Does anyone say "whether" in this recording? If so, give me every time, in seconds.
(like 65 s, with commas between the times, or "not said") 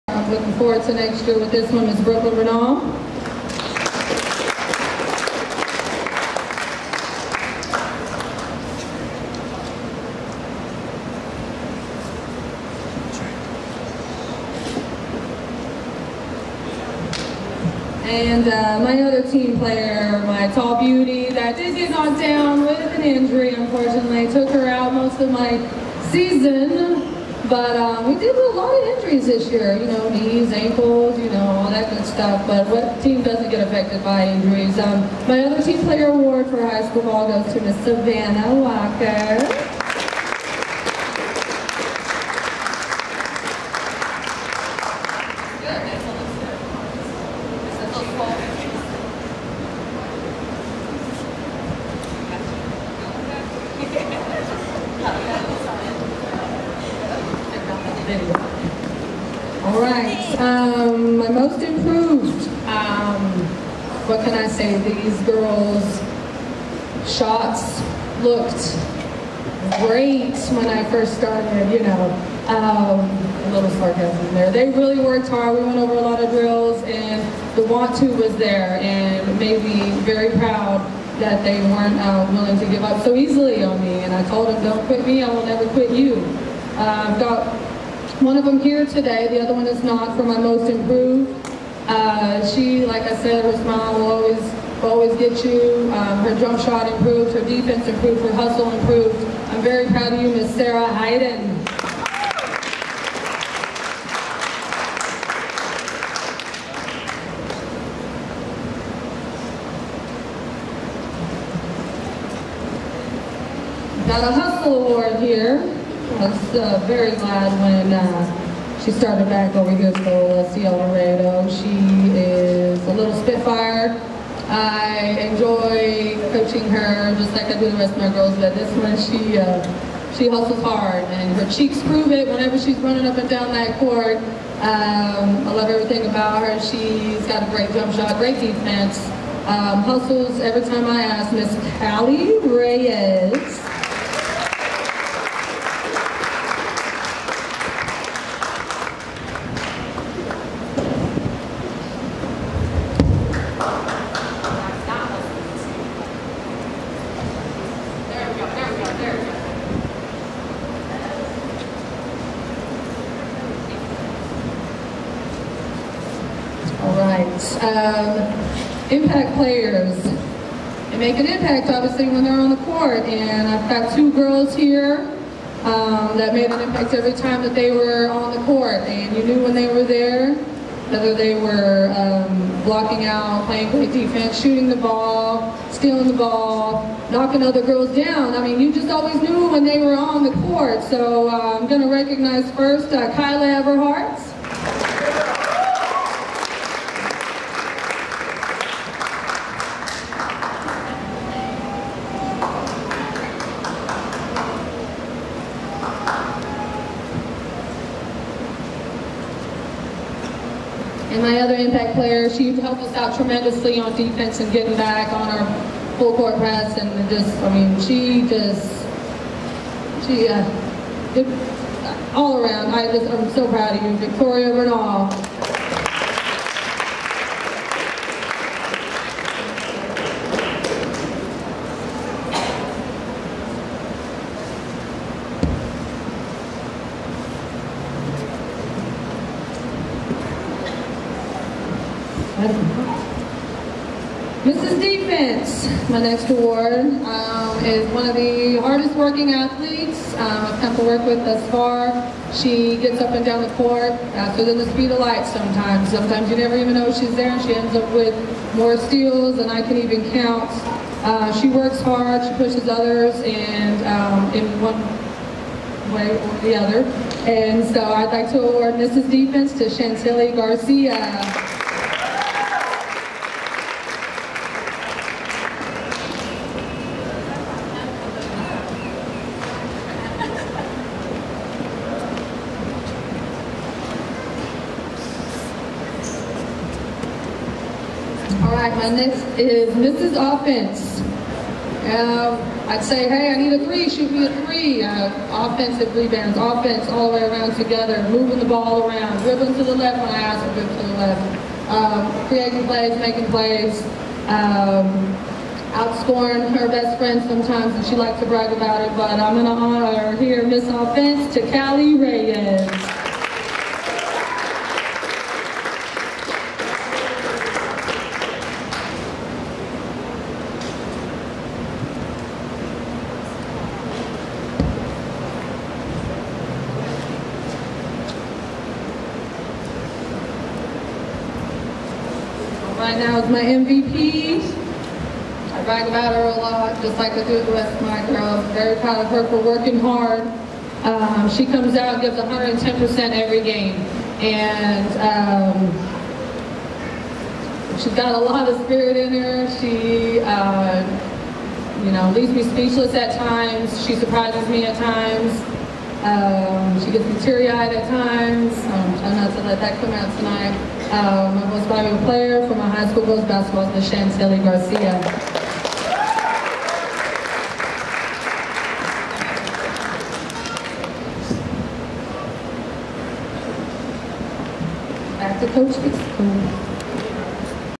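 180 s.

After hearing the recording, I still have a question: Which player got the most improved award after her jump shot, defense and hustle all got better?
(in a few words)
Sarah Hayden.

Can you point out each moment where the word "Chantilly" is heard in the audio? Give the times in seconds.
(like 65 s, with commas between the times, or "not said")
269 s, 363 s.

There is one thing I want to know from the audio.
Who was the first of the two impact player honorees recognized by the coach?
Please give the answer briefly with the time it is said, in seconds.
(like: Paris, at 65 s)
Kyla Everhart, at 193 s.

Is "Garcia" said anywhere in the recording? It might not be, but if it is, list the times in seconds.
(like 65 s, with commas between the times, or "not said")
270 s, 364 s.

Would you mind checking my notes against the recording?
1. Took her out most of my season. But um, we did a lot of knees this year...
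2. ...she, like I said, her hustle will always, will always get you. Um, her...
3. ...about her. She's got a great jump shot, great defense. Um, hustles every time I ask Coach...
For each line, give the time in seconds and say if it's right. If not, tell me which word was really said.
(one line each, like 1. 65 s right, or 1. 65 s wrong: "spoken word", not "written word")
1. 24 s wrong: "injuries", not "knees"
2. 92 s wrong: "smile", not "hustle"
3. 136 s wrong: "Miss", not "Coach".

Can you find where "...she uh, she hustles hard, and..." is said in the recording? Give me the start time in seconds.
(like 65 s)
128 s.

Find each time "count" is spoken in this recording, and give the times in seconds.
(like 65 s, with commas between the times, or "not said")
260 s.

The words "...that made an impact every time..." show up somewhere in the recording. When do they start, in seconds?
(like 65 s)
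176 s.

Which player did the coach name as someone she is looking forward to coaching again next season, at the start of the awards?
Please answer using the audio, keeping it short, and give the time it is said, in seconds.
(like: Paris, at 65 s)
Brooklyn Renault, at 2 s.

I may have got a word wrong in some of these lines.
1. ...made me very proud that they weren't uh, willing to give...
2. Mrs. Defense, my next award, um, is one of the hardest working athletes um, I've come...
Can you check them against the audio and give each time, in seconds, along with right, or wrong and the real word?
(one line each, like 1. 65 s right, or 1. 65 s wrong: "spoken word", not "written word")
1. 79 s right
2. 244 s right.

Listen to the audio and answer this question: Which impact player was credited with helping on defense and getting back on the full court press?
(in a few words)
Victoria Bernal.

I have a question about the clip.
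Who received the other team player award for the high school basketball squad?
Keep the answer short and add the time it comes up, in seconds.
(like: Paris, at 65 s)
Savannah Walker, at 37 s.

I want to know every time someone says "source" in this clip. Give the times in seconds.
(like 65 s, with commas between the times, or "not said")
not said.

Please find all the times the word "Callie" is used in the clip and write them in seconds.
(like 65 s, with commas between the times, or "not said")
141 s, 311 s.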